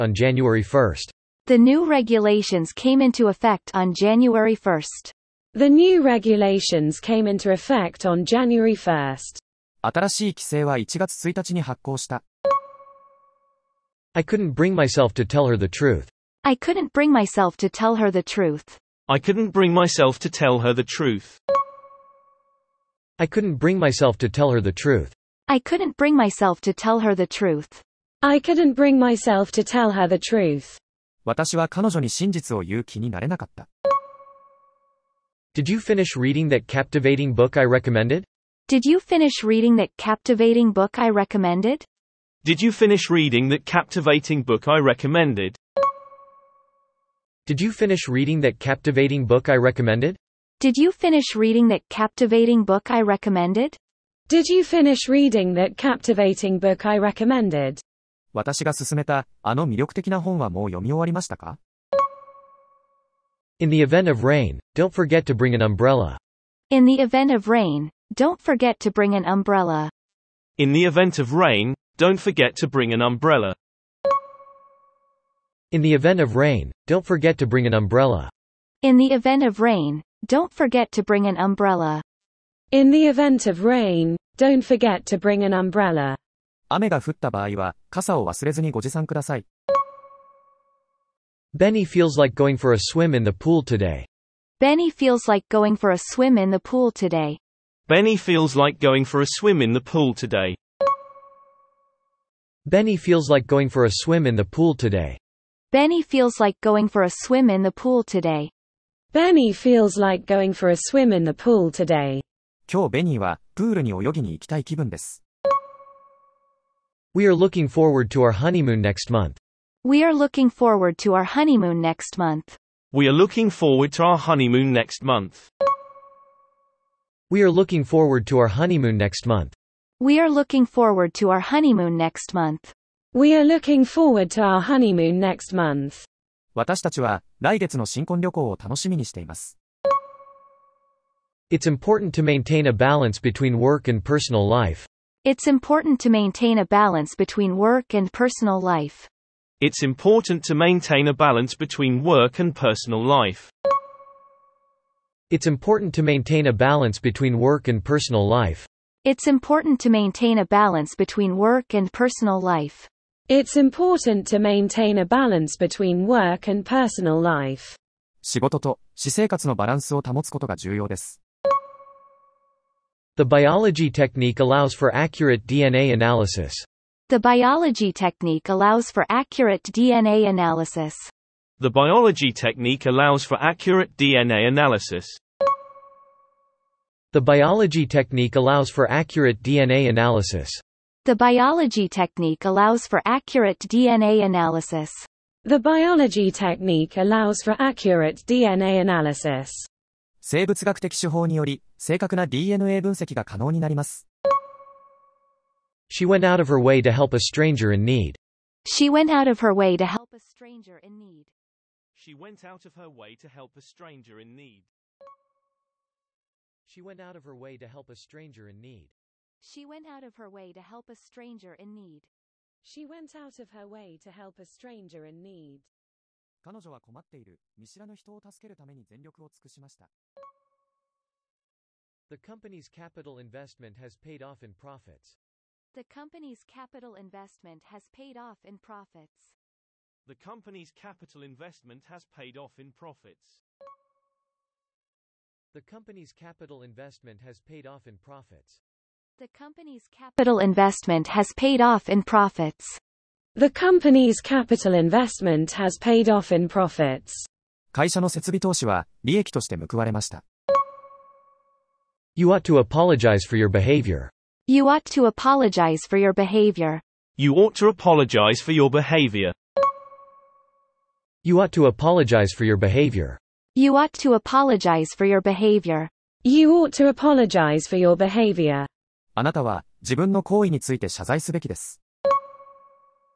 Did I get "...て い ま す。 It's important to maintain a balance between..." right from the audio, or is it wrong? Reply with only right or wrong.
right.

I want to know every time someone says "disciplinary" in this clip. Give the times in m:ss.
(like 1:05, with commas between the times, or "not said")
not said.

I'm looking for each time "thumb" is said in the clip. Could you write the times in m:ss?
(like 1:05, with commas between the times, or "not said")
not said.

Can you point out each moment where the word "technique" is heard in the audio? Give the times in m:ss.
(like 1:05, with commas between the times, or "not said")
2:53, 2:57, 3:02, 3:07, 3:11, 3:16.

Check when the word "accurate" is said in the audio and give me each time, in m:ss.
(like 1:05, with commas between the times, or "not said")
2:54, 2:59, 3:03, 3:08, 3:13, 3:17.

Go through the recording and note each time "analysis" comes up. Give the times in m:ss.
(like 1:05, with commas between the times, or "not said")
2:55, 3:00, 3:04, 3:09, 3:14, 3:18.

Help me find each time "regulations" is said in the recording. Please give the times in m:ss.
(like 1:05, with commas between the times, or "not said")
0:01, 0:06.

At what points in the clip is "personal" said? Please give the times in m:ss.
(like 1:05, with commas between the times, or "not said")
2:24, 2:28, 2:32, 2:37, 2:41, 2:46.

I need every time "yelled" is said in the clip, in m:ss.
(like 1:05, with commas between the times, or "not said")
not said.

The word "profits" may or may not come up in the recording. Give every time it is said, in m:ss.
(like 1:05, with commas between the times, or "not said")
3:54, 3:58, 4:02, 4:07, 4:12, 4:16.